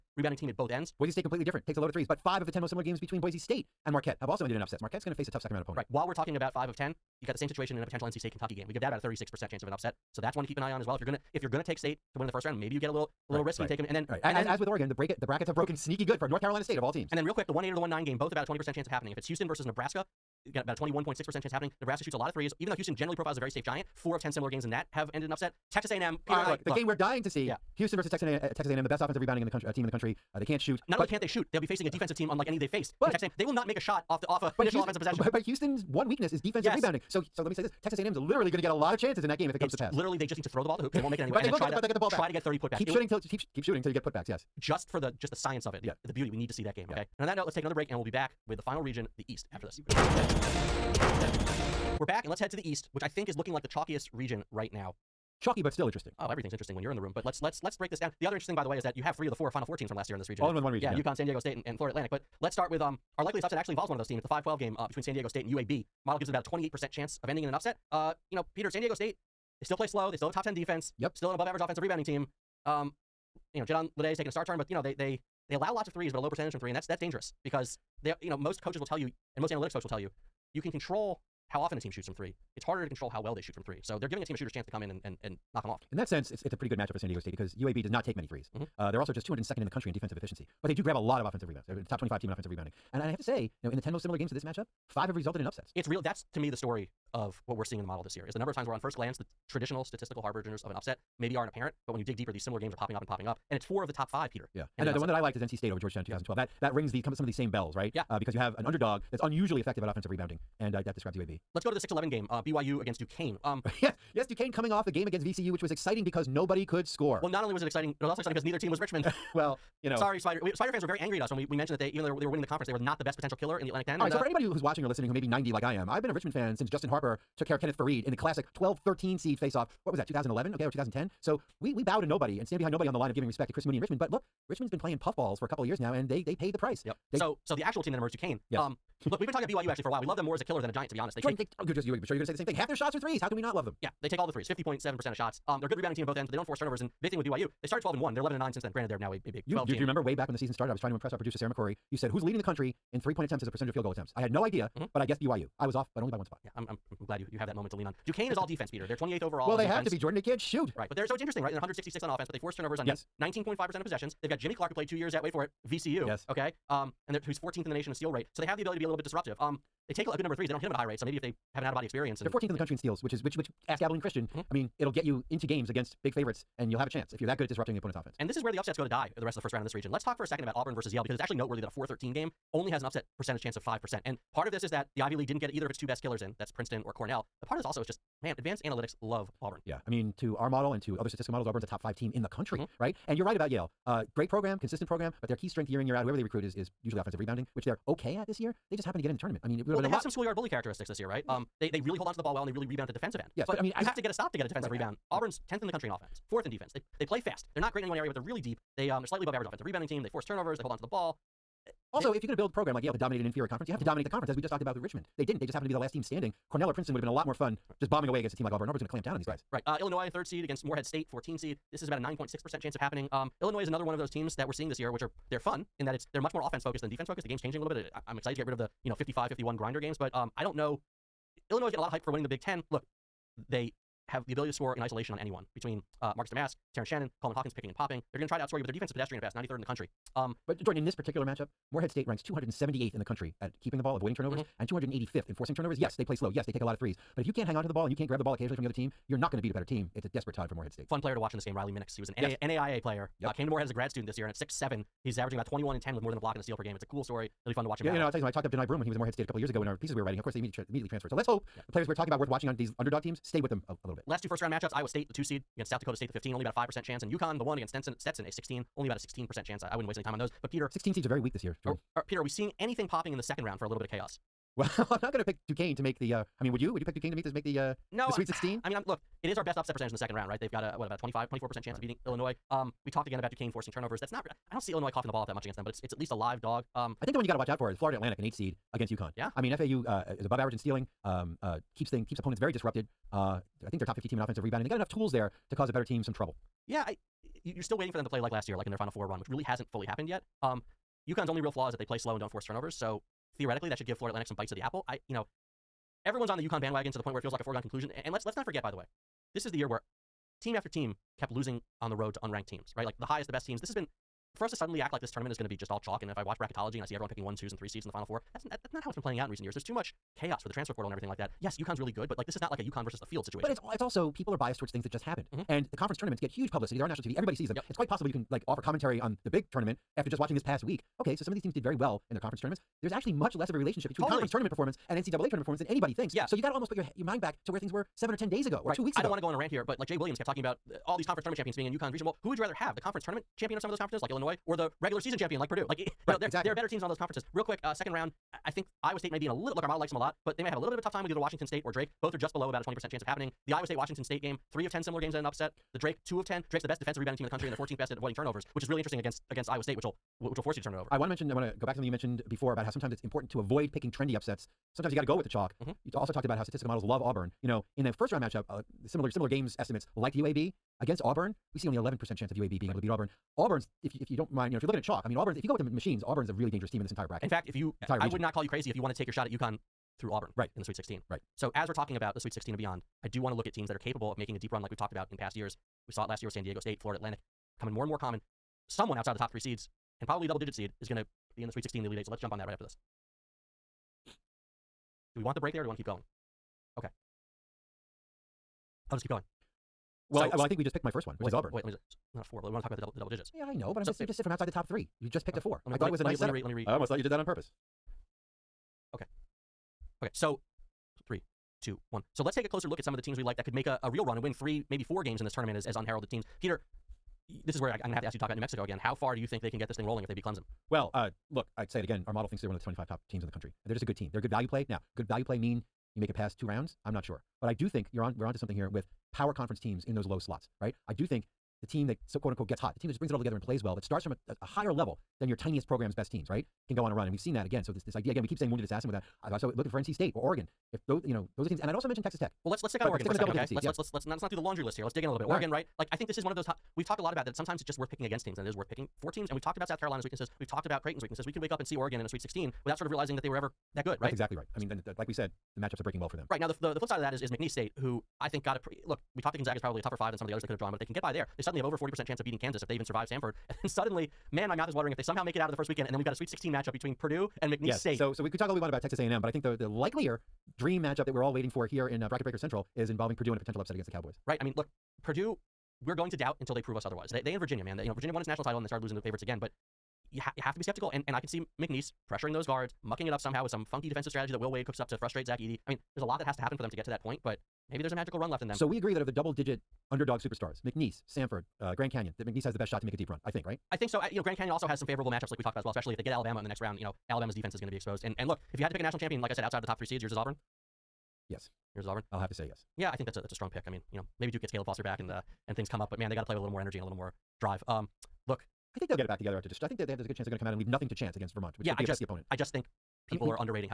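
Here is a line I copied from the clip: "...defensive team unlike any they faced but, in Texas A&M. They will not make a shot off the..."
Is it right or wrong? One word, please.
right.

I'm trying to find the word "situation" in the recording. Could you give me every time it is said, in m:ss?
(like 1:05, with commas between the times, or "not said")
0:07, 5:23.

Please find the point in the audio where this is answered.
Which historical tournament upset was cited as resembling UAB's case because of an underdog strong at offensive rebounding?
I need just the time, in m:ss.
1:45.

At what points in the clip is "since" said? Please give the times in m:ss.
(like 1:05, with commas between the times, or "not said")
2:06, 2:28.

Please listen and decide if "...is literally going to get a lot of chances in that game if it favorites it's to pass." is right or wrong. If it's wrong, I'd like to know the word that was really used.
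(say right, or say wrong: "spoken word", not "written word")
wrong: "comes", not "favorites".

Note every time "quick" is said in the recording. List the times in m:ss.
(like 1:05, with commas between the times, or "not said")
0:17, 5:47.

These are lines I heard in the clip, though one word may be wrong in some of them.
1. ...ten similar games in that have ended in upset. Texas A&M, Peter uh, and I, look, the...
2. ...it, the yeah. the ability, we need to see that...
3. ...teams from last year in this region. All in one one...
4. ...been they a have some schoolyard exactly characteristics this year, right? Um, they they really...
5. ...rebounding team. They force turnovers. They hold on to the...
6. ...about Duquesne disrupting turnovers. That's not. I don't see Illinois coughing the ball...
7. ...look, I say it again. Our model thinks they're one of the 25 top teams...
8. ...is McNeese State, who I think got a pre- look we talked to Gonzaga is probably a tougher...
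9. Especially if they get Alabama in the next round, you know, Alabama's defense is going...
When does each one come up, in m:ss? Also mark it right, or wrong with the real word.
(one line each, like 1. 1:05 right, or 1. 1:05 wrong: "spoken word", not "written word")
1. 0:24 right
2. 0:45 wrong: "beauty", not "ability"
3. 0:59 right
4. 3:19 wrong: "bully", not "exactly"
5. 3:29 right
6. 4:43 wrong: "forcing", not "disrupting"
7. 7:01 right
8. 7:37 right
9. 8:15 right.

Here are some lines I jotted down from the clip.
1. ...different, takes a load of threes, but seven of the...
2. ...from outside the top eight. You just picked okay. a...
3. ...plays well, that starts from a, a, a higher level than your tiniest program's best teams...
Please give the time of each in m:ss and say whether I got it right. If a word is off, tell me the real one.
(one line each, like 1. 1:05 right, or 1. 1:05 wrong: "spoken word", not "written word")
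1. 0:01 wrong: "five", not "seven"
2. 6:44 wrong: "three", not "eight"
3. 7:13 right.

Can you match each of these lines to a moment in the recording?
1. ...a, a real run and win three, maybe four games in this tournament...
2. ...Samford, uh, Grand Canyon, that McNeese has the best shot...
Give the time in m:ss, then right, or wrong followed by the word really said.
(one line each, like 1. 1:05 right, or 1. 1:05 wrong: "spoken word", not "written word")
1. 6:53 right
2. 8:11 right.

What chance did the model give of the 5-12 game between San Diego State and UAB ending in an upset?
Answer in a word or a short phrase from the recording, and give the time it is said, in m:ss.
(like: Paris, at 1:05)
28%, at 1:06.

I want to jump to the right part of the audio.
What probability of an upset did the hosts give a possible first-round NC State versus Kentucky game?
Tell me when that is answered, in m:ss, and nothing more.
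0:08.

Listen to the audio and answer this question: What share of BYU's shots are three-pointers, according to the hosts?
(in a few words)
50.7%.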